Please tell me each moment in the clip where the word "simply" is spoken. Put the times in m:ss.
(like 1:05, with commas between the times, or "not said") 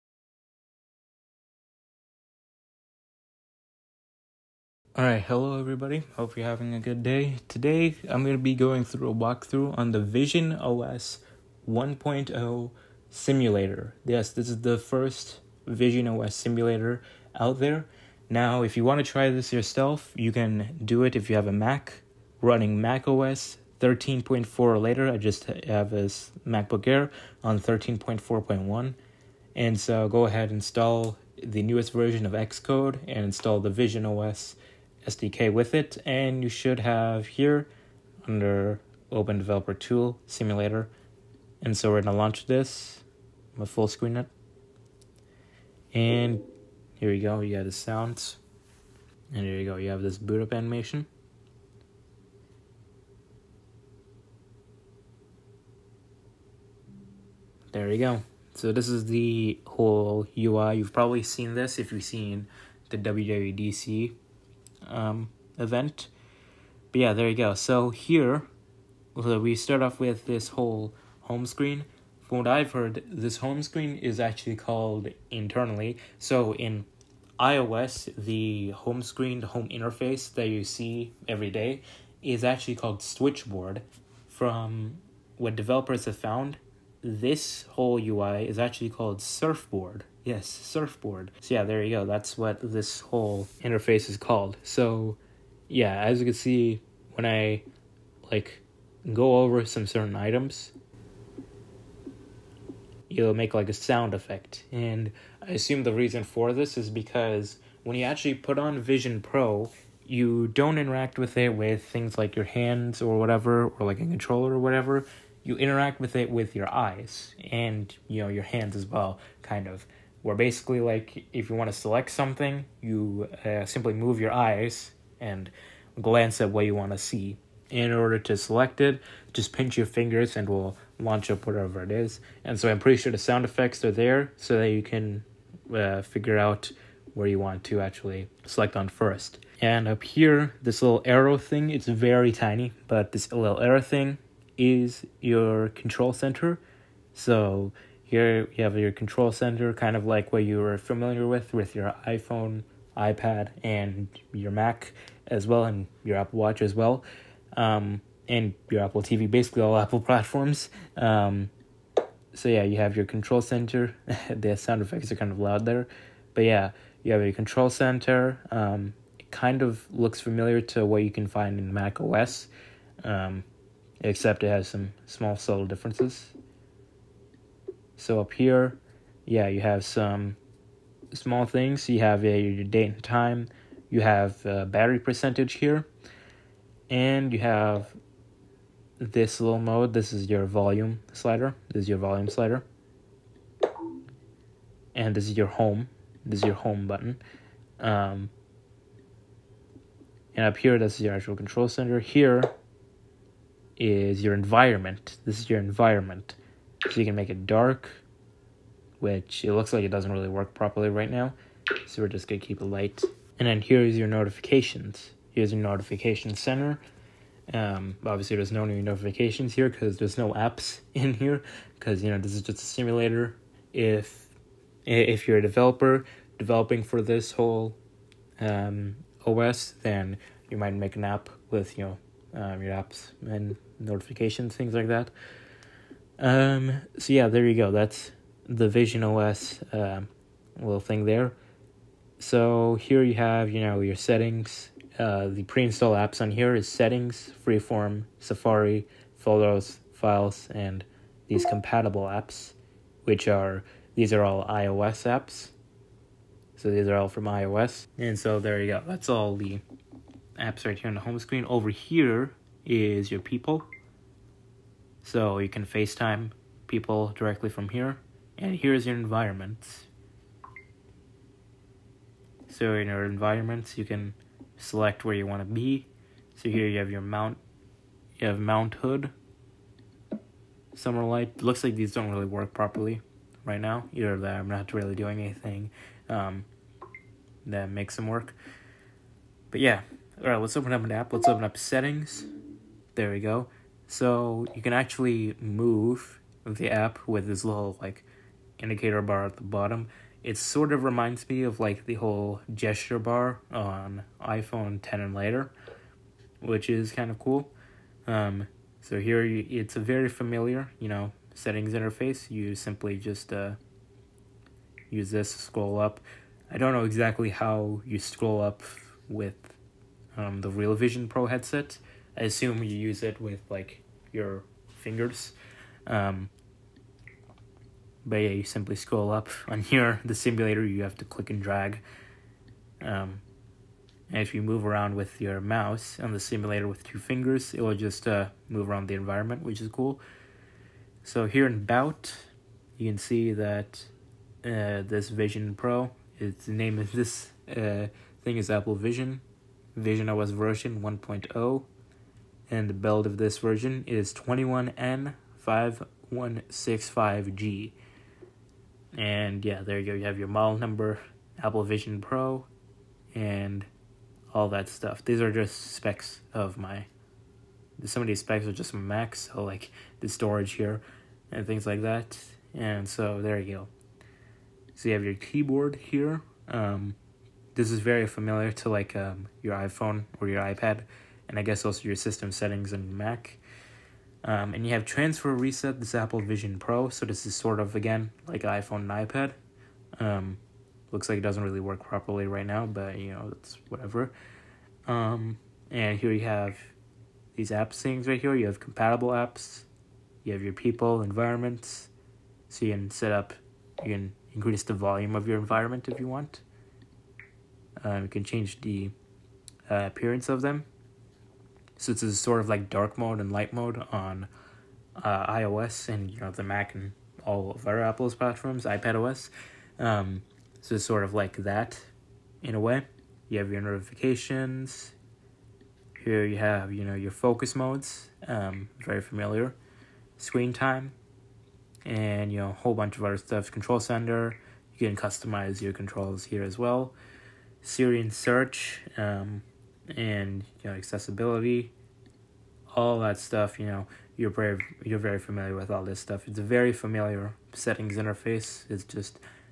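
2:03, 5:12, 5:28.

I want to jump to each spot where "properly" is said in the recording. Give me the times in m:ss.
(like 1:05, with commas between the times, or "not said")
3:30, 4:42, 6:31.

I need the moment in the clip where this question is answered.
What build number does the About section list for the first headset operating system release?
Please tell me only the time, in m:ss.
5:54.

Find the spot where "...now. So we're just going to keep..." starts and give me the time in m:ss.
3:31.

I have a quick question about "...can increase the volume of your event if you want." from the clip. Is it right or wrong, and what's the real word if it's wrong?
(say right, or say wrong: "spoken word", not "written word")
wrong: "environment", not "event".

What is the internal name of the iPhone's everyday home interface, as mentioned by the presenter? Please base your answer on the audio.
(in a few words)
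Switchboard.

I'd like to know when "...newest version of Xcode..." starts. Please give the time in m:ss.
0:31.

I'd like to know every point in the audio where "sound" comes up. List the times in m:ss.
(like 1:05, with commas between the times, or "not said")
0:47, 1:43, 2:13, 2:44.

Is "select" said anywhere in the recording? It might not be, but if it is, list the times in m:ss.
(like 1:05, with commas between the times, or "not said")
2:01, 2:08, 2:18, 4:34.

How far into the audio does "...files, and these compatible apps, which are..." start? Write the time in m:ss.
4:09.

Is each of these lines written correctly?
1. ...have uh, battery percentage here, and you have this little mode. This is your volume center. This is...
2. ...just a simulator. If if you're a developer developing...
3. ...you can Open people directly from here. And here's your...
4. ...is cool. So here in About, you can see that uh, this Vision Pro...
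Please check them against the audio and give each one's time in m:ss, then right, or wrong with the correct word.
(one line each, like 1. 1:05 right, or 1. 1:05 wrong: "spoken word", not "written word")
1. 3:04 wrong: "slider", not "center"
2. 3:42 right
3. 4:25 wrong: "FaceTime", not "Open"
4. 5:39 right.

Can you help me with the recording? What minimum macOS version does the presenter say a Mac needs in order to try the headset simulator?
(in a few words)
13.4.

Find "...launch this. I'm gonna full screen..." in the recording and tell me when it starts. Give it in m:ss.
0:42.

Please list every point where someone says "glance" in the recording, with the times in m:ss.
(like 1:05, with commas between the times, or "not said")
2:06.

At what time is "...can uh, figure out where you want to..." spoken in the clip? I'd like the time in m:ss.
2:14.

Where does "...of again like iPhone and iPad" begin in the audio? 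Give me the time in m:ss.
6:27.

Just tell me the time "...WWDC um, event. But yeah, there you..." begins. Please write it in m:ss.
1:02.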